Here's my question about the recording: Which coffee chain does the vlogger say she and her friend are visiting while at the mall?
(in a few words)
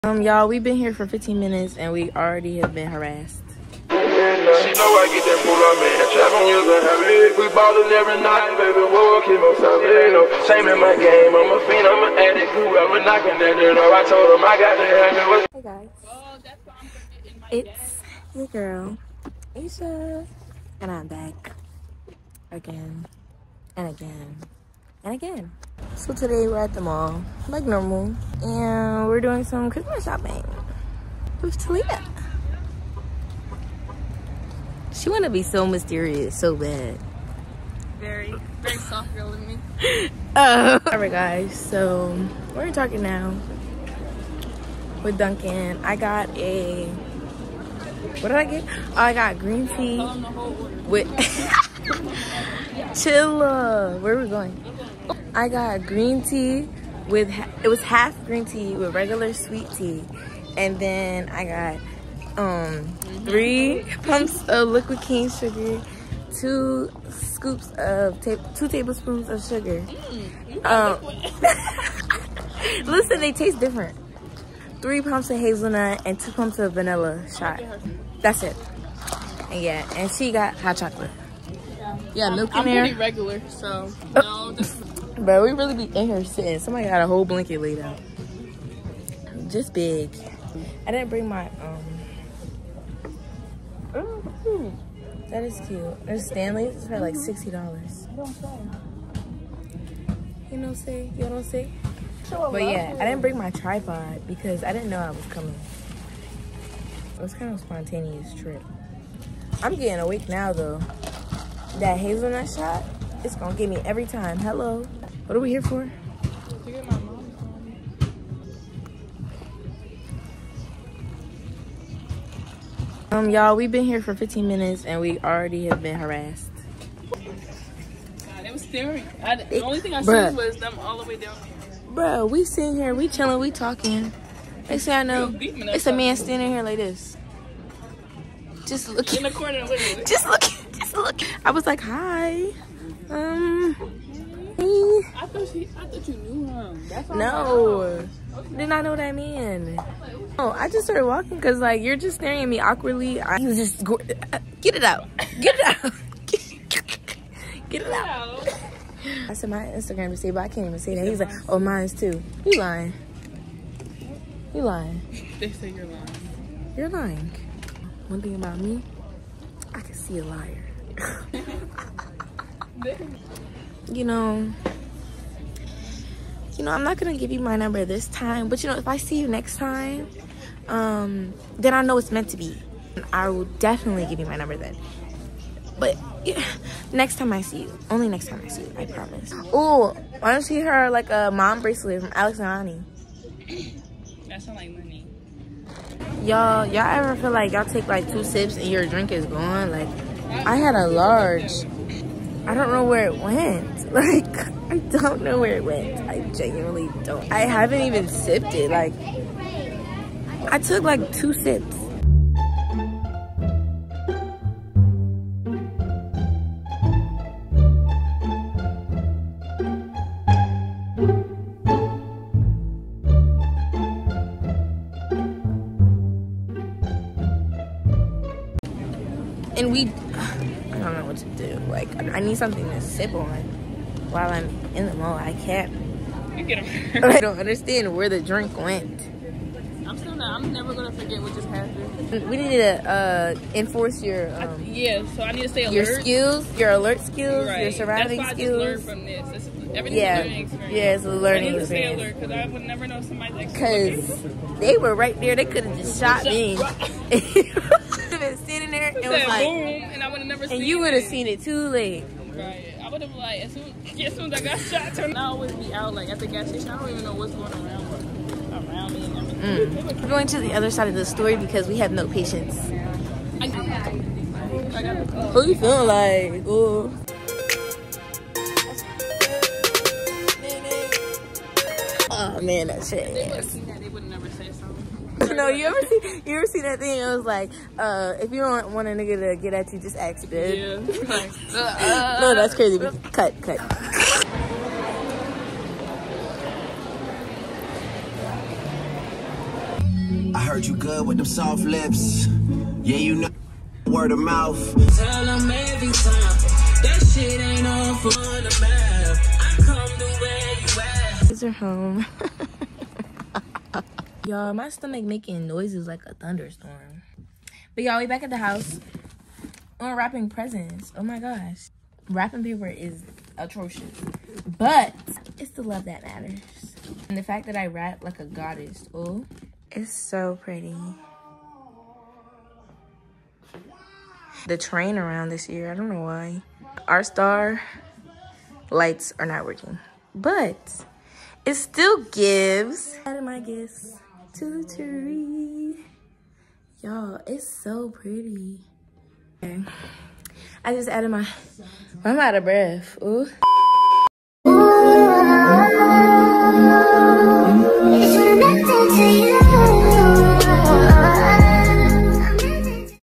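Dunkin'.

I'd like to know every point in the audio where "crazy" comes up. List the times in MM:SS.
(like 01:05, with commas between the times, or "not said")
04:52.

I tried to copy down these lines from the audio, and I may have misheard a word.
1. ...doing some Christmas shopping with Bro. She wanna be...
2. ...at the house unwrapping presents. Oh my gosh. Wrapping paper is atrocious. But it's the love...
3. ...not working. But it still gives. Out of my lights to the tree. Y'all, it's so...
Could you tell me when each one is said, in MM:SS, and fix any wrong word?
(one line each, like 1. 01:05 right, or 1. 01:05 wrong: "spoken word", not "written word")
1. 00:29 wrong: "Talia", not "Bro"
2. 05:18 right
3. 05:39 wrong: "gifts", not "lights".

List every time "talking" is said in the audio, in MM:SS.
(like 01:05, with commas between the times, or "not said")
00:42, 02:13.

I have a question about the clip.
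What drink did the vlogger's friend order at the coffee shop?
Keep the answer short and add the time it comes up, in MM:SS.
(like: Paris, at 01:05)
Hot chocolate, at 01:20.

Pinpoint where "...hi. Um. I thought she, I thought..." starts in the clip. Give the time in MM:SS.
02:21.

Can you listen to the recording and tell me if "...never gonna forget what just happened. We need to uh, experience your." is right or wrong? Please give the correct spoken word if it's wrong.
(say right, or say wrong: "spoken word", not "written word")
wrong: "enforce", not "experience".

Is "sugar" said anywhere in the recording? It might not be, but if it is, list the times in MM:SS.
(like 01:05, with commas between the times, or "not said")
01:05, 01:09.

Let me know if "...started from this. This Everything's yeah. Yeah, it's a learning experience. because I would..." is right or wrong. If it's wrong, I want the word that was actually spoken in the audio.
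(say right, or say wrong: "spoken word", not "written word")
wrong: "learned", not "started".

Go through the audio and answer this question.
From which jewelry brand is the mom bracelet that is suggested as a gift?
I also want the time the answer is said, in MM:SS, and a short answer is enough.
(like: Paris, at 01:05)
Alex and Ani, at 03:12.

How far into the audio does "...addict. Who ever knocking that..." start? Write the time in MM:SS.
00:12.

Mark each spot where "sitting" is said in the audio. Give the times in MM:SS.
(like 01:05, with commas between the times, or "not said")
01:26, 02:12, 04:18.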